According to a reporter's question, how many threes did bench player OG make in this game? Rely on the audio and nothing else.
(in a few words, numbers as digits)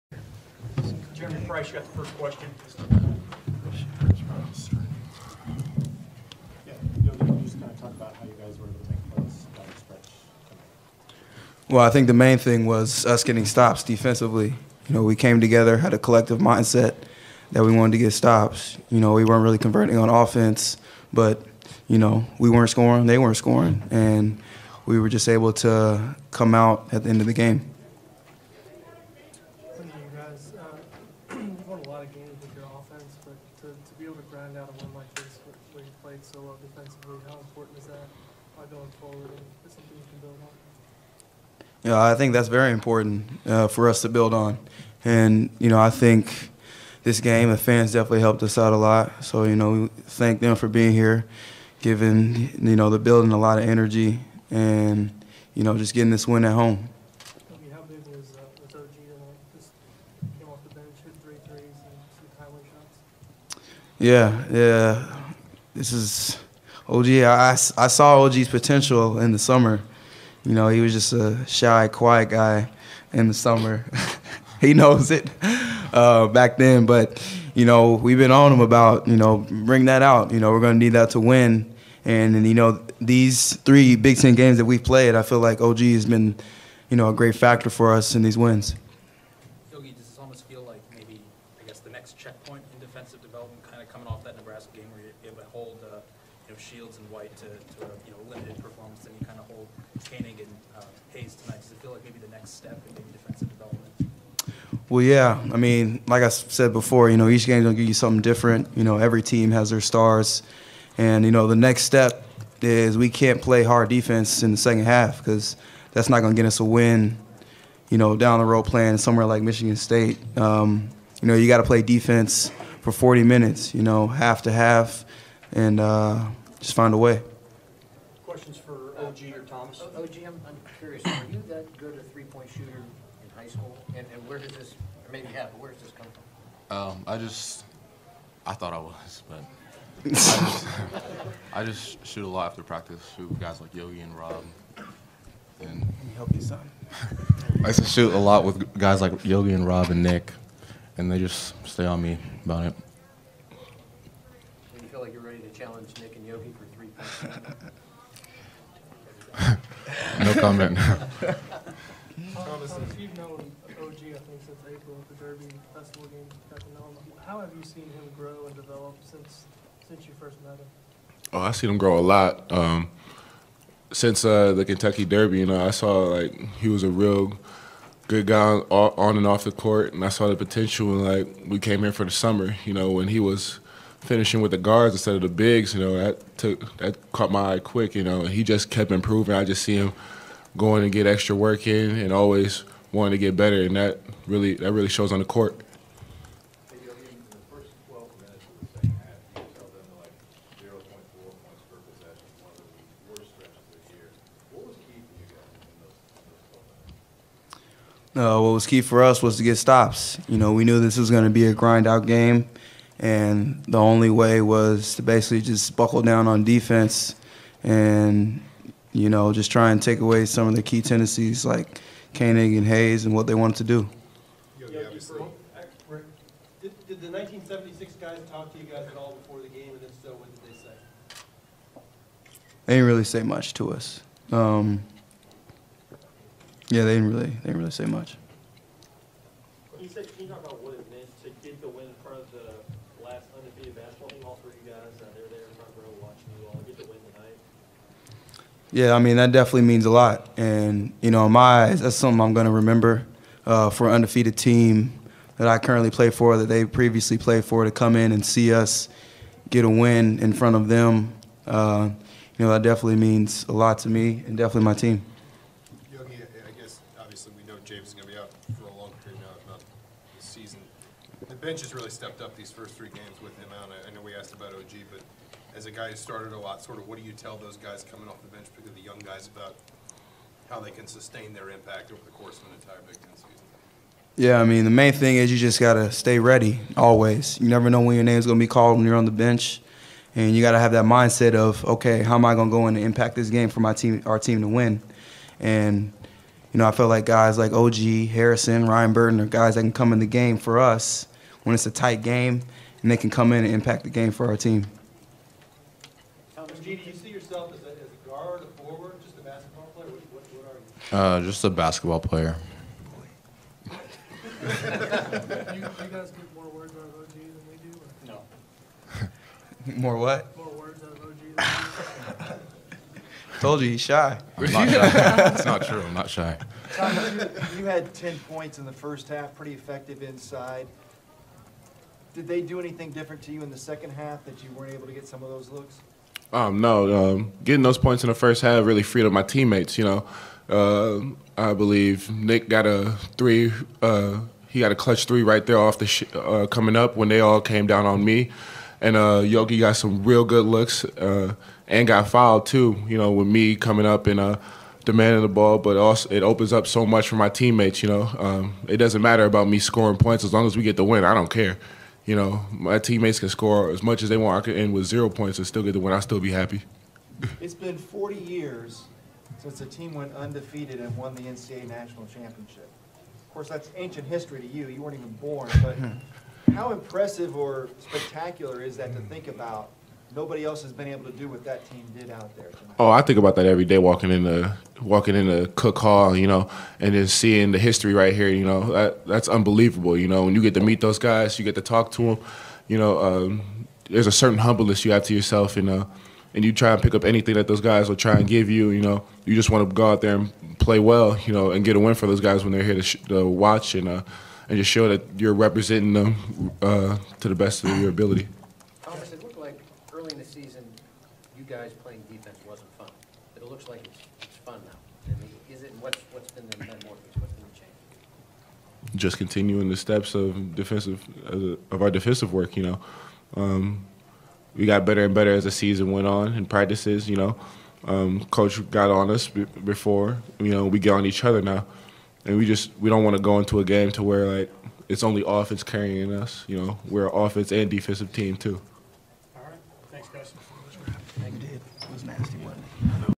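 3.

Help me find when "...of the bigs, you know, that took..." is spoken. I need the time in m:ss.
3:05.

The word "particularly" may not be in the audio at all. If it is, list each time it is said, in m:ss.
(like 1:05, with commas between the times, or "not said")
4:38.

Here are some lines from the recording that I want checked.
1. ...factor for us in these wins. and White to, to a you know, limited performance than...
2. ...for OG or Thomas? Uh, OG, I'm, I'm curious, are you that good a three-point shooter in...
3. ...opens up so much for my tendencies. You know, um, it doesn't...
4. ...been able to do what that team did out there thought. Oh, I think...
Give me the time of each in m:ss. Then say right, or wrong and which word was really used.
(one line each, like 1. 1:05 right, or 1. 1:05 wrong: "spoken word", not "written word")
1. 1:27 right
2. 2:08 right
3. 5:56 wrong: "teammates", not "tendencies"
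4. 6:20 wrong: "tonight", not "thought".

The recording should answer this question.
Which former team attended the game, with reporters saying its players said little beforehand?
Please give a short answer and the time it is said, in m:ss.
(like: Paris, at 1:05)
1976 team, at 3:47.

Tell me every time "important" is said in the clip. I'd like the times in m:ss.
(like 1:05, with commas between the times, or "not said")
0:37, 0:42.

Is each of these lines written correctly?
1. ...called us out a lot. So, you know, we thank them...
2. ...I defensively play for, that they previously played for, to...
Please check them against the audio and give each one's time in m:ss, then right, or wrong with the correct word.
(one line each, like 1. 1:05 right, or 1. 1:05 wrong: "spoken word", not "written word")
1. 0:48 wrong: "helped", not "called"
2. 4:15 wrong: "currently", not "defensively".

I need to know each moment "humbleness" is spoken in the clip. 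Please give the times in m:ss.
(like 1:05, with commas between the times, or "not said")
6:34.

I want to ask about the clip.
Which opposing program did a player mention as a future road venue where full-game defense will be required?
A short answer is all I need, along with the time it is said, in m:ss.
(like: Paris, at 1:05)
Michigan State, at 1:59.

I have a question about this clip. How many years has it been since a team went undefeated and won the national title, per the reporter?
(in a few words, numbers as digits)
40.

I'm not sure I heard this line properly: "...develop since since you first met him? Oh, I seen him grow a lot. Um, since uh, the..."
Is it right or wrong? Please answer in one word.
right.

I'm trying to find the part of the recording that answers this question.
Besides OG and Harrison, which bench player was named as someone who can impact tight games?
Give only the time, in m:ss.
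4:58.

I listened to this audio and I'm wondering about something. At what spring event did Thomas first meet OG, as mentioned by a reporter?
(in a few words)
Derby Festival game.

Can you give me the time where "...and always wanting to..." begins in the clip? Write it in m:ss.
3:11.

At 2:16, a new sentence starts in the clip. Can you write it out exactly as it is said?
Um, I just, I thought I was, but I, just, I just shoot a lot after practice.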